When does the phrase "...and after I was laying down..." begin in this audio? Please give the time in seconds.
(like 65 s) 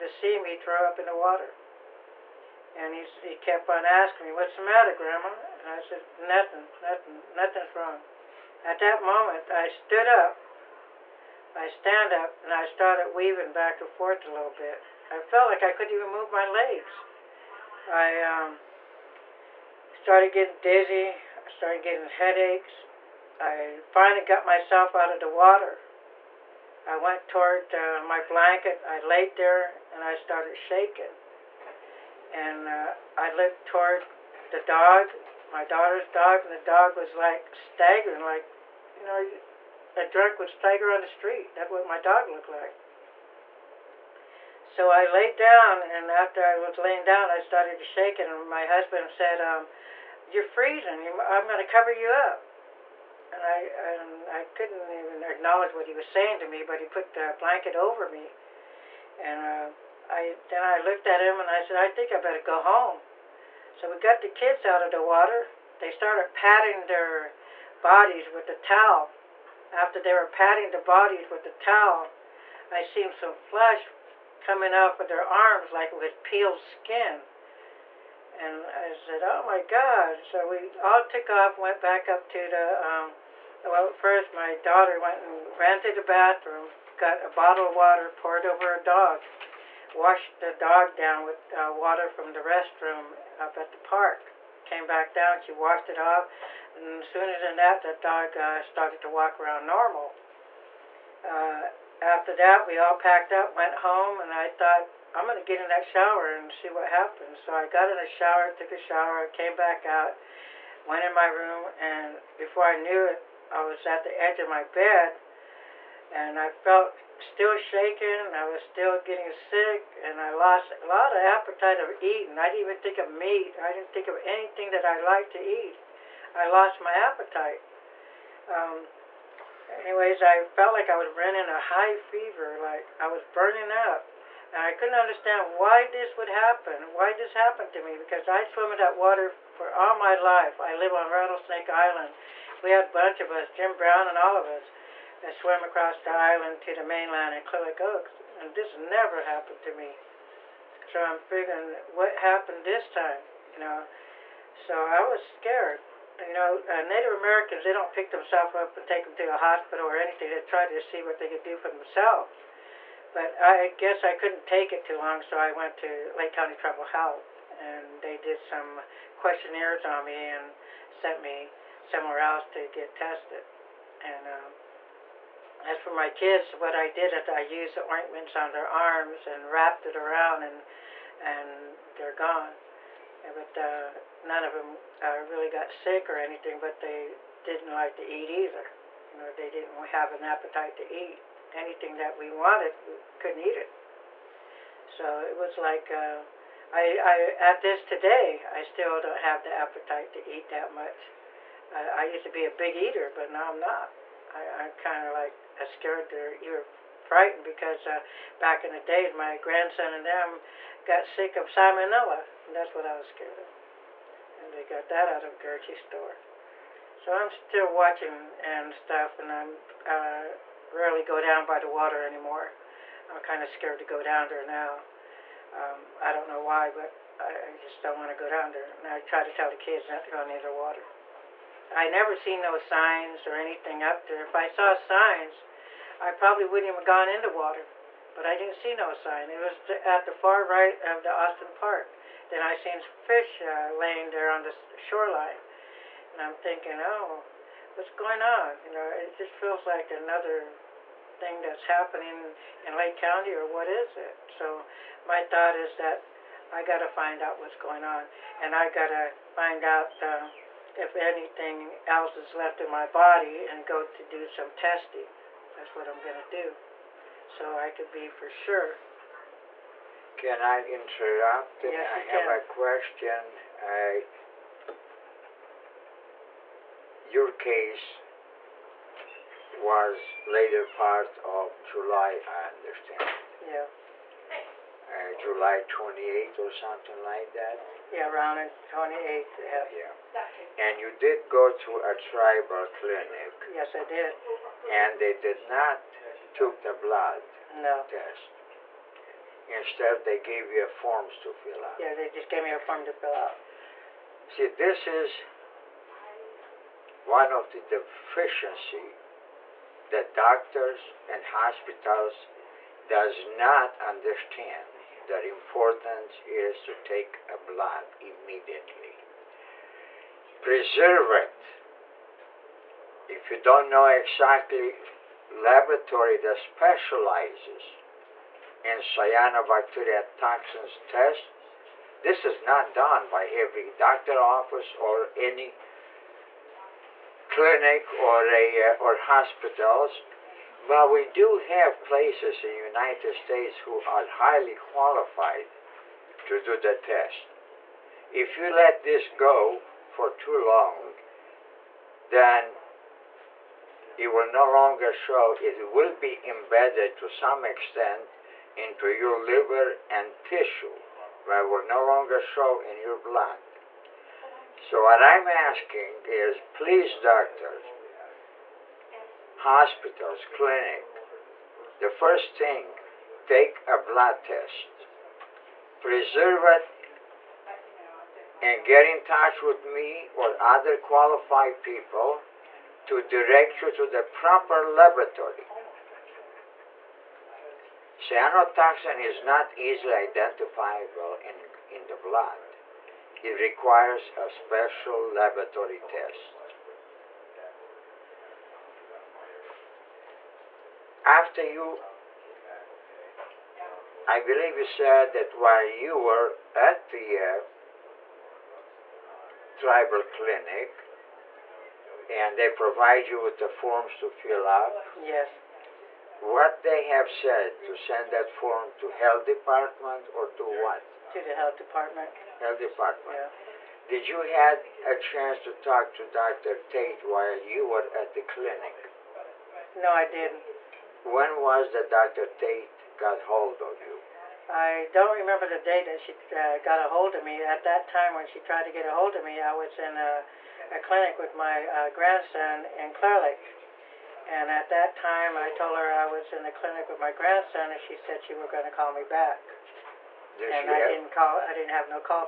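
45 s.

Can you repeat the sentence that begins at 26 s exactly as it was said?
I went toward uh, my blanket.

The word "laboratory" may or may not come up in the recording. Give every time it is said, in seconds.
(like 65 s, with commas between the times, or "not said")
325 s, 384 s, 394 s.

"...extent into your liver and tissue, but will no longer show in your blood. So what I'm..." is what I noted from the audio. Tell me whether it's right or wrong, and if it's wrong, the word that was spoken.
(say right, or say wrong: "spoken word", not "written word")
right.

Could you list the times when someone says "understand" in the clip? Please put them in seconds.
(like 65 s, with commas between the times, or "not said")
134 s, 282 s, 313 s.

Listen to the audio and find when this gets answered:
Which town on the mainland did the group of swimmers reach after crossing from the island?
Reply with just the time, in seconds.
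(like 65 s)
147 s.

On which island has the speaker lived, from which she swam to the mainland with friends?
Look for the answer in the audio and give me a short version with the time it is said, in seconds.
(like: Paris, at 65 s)
Rattlesnake Island, at 141 s.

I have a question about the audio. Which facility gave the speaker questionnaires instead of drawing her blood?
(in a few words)
Lake County Tribal Health.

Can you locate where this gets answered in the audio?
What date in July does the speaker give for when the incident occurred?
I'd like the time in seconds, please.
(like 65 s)
285 s.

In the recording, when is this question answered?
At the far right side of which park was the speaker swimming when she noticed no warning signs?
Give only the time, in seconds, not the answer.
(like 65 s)
241 s.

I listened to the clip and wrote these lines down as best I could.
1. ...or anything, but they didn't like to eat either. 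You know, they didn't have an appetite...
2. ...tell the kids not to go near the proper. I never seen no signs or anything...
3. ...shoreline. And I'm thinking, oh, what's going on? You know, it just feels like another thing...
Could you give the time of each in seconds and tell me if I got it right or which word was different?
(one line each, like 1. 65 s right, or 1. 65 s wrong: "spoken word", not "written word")
1. 186 s right
2. 229 s wrong: "water", not "proper"
3. 244 s right.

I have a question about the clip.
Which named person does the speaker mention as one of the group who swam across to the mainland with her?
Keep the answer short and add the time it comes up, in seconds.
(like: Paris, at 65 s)
Jim Brown, at 143 s.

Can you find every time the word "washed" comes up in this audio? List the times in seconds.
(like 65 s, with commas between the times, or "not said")
89 s, 95 s.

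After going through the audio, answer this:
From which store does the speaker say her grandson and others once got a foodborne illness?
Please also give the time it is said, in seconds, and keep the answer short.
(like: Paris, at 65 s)
Gertie's store, at 215 s.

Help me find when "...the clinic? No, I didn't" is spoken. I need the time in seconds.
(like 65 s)
428 s.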